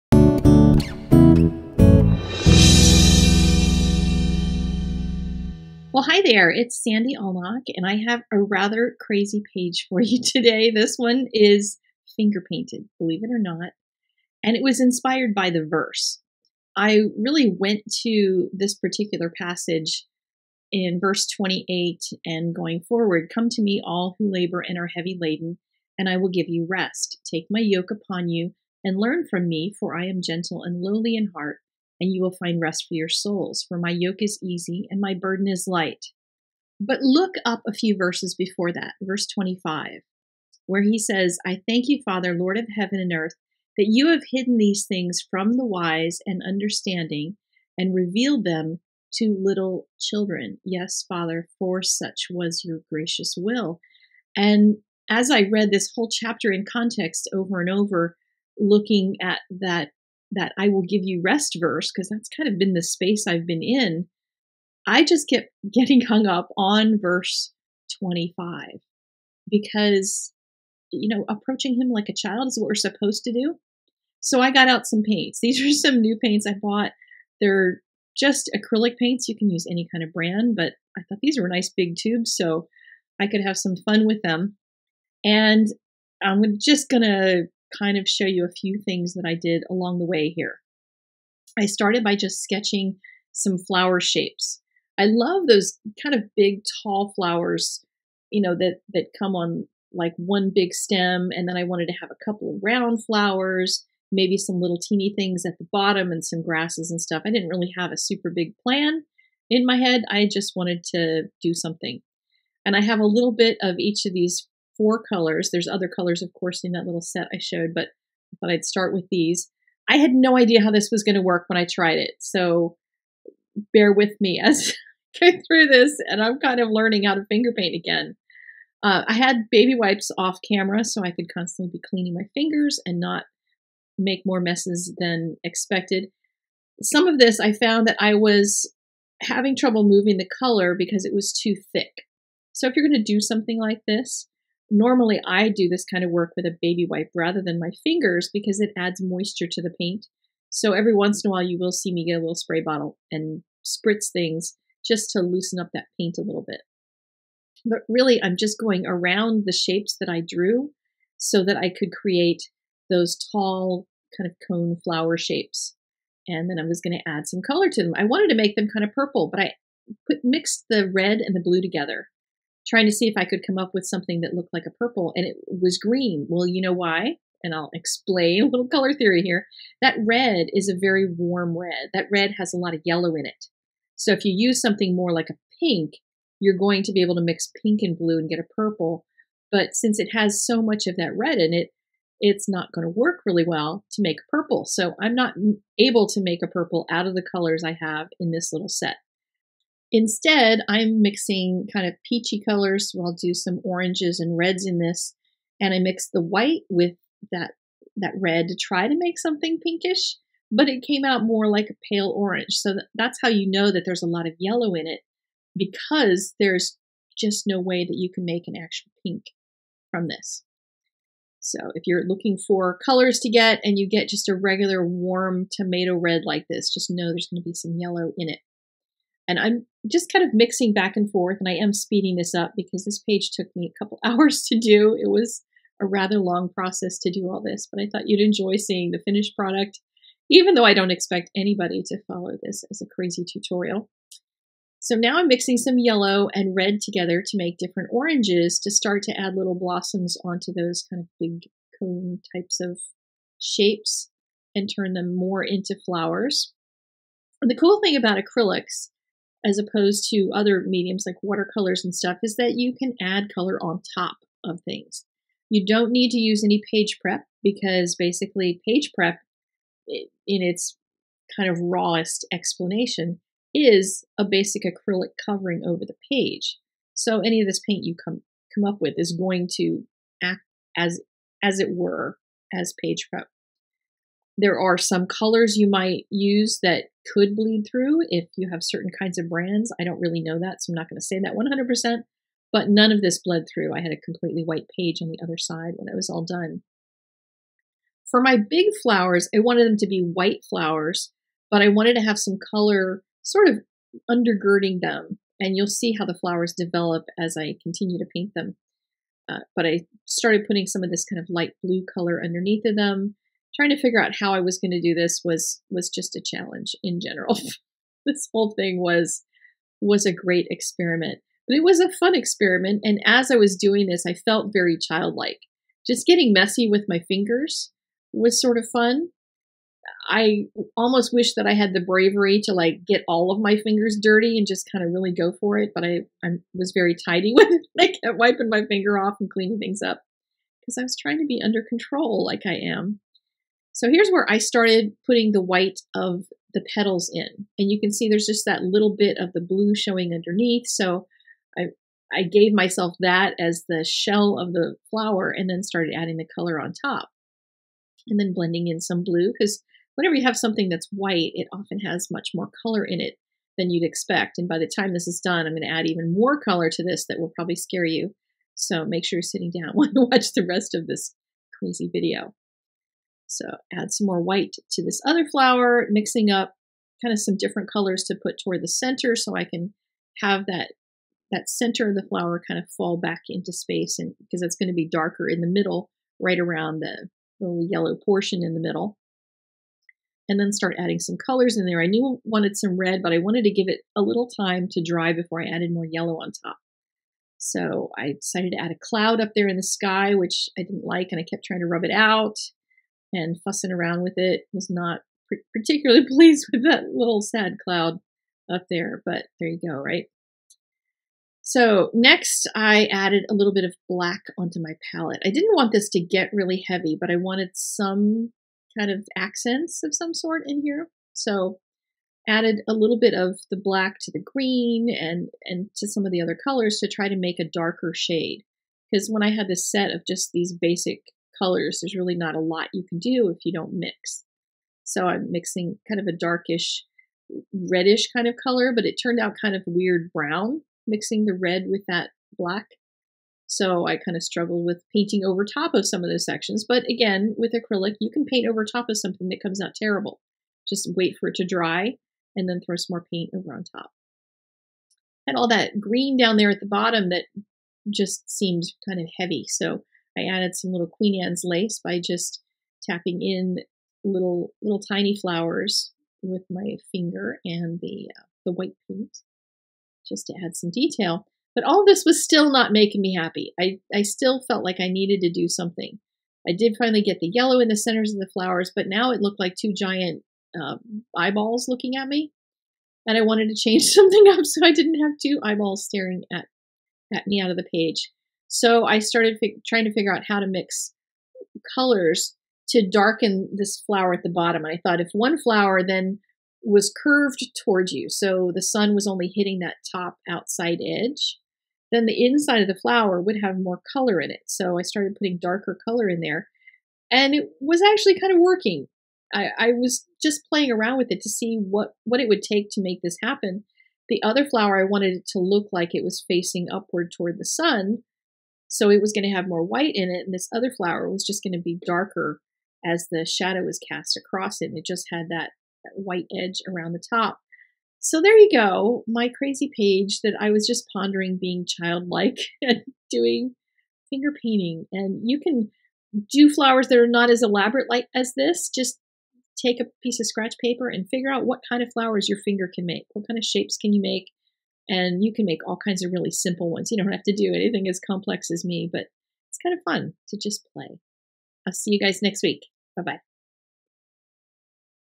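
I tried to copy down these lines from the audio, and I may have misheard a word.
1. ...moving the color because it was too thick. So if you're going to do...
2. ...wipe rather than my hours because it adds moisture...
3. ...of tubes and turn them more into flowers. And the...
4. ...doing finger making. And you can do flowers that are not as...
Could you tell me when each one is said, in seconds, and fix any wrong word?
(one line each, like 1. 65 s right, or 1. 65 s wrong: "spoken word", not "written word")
1. 139 s right
2. 146 s wrong: "fingers", not "hours"
3. 252 s wrong: "shapes", not "tubes"
4. 533 s wrong: "painting", not "making".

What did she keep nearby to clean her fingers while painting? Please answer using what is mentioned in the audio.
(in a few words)
baby wipes.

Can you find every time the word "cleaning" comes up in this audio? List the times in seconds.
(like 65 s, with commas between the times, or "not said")
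131 s, 339 s.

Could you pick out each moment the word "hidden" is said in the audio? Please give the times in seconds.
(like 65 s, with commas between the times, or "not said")
44 s.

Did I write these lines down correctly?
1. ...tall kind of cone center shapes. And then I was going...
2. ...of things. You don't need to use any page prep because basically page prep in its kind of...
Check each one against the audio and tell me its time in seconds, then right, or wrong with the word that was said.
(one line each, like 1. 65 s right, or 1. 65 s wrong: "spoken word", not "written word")
1. 163 s wrong: "flower", not "center"
2. 264 s right.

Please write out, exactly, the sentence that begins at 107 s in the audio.
I didn't really have a super big plan in my head.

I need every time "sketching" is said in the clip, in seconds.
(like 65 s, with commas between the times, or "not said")
92 s.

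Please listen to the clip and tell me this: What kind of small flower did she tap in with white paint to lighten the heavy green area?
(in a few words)
Queen Anne's lace.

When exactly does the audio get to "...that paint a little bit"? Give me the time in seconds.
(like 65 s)
155 s.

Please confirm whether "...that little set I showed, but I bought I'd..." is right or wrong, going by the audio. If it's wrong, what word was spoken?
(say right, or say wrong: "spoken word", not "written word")
wrong: "thought", not "bought".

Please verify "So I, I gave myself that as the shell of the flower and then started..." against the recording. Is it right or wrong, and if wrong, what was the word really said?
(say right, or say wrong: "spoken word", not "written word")
right.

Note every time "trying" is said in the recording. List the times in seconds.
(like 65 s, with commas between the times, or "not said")
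172 s, 313 s, 340 s, 401 s, 489 s.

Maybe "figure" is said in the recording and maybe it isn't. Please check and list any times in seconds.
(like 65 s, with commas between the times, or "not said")
313 s, 489 s, 541 s.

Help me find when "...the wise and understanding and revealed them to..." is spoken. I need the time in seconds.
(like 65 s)
45 s.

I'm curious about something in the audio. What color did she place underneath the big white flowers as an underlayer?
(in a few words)
light blue.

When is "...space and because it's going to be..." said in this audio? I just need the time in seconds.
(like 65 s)
383 s.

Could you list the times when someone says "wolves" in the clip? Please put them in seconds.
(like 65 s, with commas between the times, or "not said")
not said.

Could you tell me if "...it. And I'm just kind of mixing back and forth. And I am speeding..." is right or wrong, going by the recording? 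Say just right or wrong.
right.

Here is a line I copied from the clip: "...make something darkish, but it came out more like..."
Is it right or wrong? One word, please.
wrong.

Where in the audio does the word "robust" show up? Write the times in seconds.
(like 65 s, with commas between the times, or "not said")
not said.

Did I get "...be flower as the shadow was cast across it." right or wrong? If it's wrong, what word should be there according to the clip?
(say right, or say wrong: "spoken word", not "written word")
wrong: "darker", not "flower".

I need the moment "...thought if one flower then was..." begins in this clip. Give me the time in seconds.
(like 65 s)
494 s.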